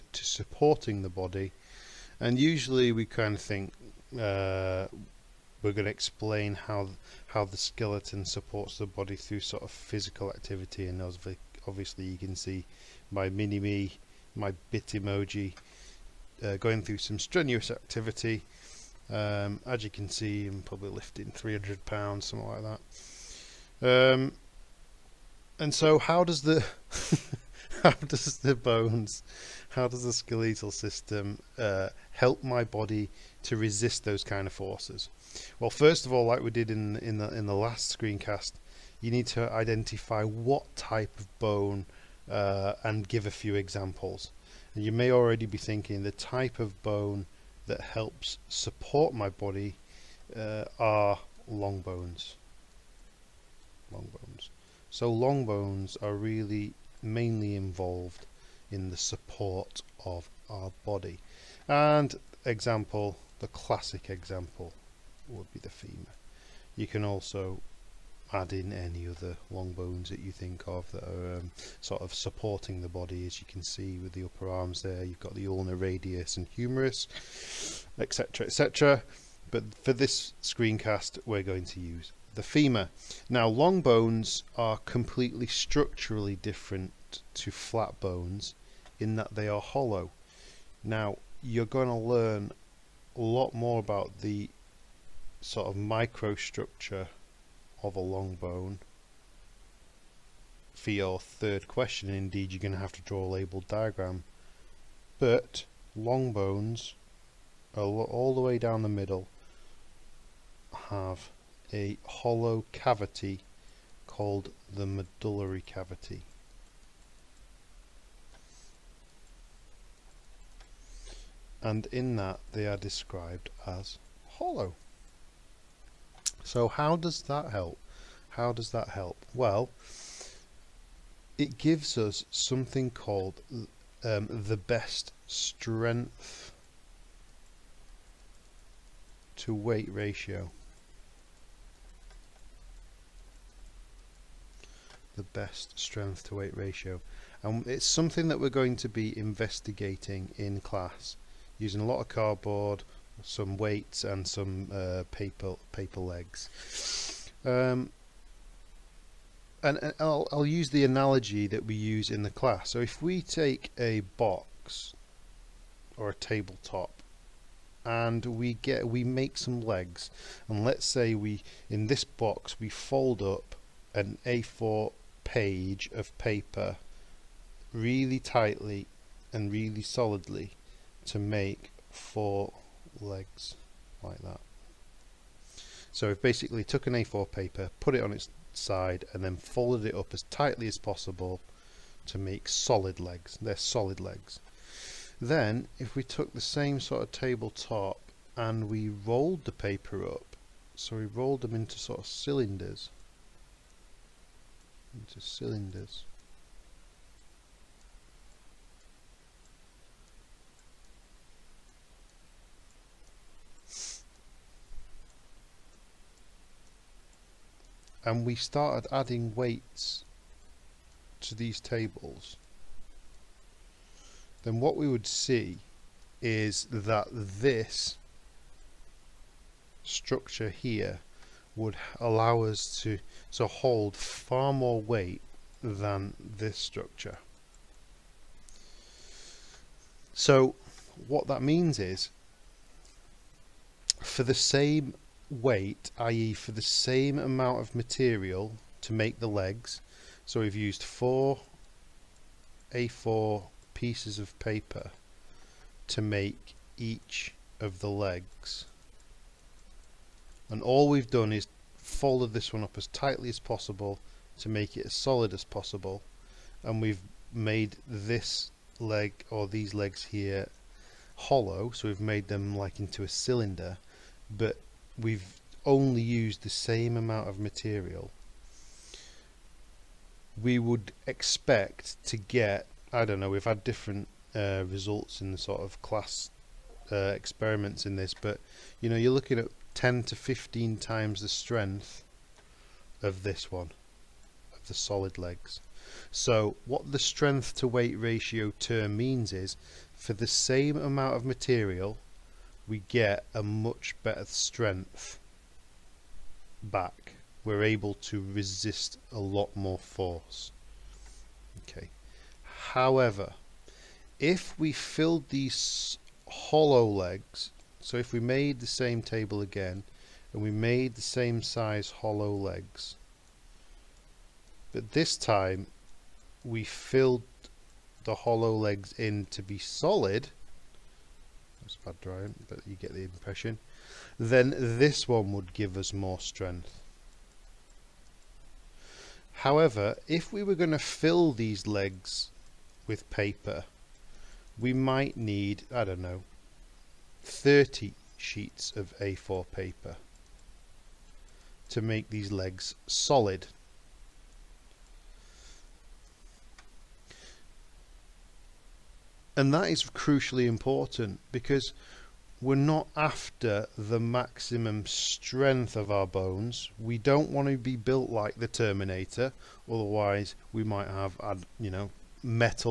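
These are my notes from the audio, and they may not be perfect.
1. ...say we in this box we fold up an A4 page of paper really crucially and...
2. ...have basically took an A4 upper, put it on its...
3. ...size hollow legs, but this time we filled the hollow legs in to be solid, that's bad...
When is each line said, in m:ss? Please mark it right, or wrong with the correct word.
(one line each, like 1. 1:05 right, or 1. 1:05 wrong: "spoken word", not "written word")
1. 2:50 wrong: "tightly", not "crucially"
2. 3:06 wrong: "paper", not "upper"
3. 5:21 right.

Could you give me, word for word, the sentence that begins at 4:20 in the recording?
And all we've done is folded this one up as tightly as possible to make it as solid as possible.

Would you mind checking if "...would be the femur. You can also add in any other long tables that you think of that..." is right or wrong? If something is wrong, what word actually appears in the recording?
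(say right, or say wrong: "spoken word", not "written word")
wrong: "bones", not "tables".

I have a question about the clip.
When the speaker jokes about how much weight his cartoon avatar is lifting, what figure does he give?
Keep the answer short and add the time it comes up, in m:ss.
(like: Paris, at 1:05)
300 pounds, at 0:21.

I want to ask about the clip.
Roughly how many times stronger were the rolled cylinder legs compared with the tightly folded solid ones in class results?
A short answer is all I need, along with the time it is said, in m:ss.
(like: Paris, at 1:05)
10 to 15 times, at 4:49.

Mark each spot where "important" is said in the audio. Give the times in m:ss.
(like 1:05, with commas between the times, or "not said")
6:00.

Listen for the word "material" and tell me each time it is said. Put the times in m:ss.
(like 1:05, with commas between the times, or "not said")
4:07, 4:37, 5:01.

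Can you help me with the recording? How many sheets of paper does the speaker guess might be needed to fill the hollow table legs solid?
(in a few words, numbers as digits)
30 sheets.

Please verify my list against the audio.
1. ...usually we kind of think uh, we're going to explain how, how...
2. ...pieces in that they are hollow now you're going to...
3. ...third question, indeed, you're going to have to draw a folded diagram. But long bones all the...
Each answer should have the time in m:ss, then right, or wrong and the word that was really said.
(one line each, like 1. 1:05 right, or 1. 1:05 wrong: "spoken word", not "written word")
1. 0:02 right
2. 1:28 wrong: "bones", not "pieces"
3. 1:41 wrong: "labelled", not "folded".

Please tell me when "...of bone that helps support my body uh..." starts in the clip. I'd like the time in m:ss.
0:46.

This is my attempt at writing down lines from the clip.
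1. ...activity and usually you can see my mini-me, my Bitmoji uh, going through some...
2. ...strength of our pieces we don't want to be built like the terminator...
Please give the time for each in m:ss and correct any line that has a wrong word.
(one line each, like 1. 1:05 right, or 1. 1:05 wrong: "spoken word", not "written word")
1. 0:10 wrong: "obviously", not "usually"
2. 6:04 wrong: "bones", not "pieces".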